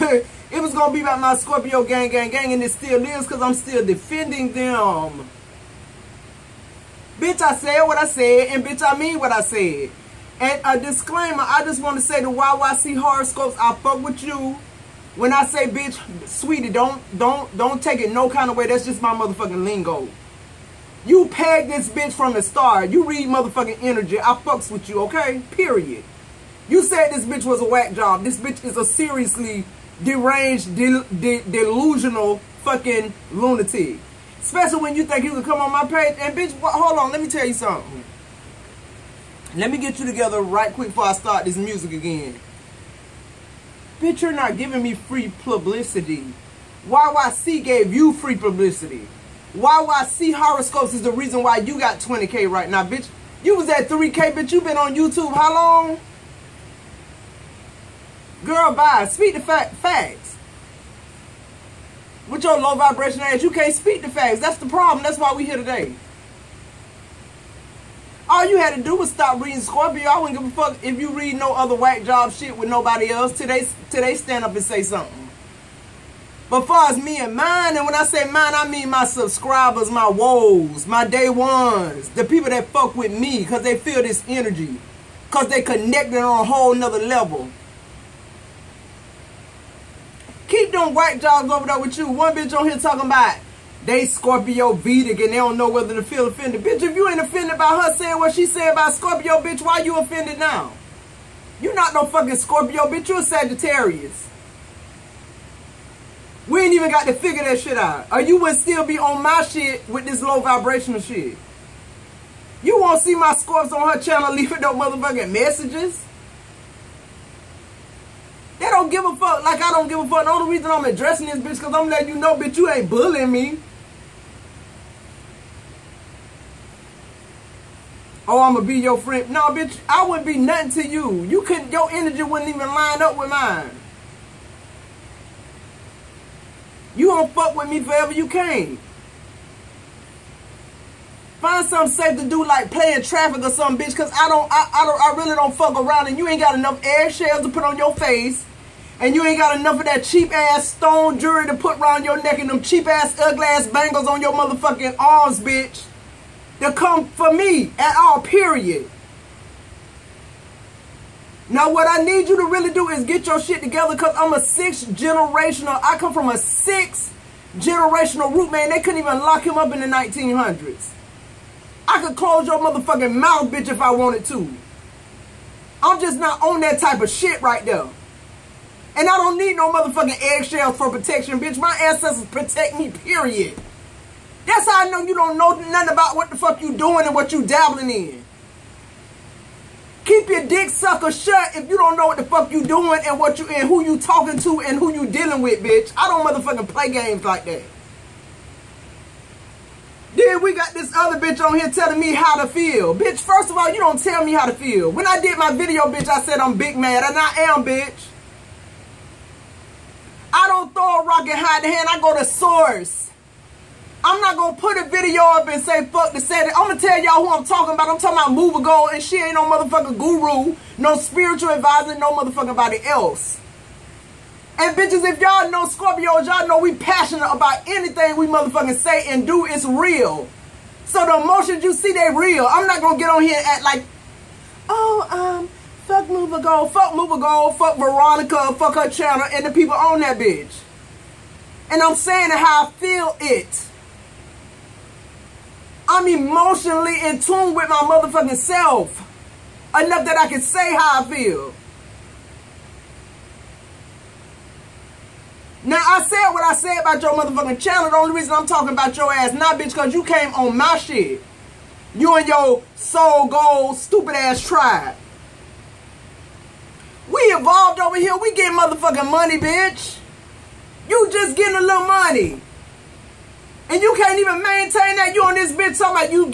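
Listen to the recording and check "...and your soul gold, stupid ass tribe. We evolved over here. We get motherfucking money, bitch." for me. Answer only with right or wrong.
right.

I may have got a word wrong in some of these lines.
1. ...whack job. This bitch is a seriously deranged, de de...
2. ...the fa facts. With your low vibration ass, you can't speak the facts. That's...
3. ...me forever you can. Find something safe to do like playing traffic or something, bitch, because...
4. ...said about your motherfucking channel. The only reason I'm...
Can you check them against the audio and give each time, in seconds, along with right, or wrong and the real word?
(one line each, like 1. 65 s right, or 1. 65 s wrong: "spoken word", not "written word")
1. 27 s right
2. 59 s right
3. 137 s right
4. 256 s right.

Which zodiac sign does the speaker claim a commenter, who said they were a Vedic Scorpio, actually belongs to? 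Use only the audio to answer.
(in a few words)
Sagittarius.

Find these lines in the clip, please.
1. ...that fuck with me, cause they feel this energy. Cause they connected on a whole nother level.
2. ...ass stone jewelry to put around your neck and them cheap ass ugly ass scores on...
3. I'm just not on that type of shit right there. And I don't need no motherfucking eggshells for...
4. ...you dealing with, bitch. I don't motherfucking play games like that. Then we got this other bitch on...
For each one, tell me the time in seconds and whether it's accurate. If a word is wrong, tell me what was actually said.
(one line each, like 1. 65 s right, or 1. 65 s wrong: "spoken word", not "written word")
1. 82 s right
2. 150 s wrong: "bangles", not "scores"
3. 175 s right
4. 194 s right.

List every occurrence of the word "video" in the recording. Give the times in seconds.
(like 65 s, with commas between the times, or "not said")
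205 s, 214 s.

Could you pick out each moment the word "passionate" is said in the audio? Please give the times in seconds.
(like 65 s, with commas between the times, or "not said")
226 s.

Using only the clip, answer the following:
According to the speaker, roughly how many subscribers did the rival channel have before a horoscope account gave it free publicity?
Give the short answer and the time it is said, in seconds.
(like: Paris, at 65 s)
3K, at 53 s.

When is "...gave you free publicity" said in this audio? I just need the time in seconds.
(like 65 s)
47 s.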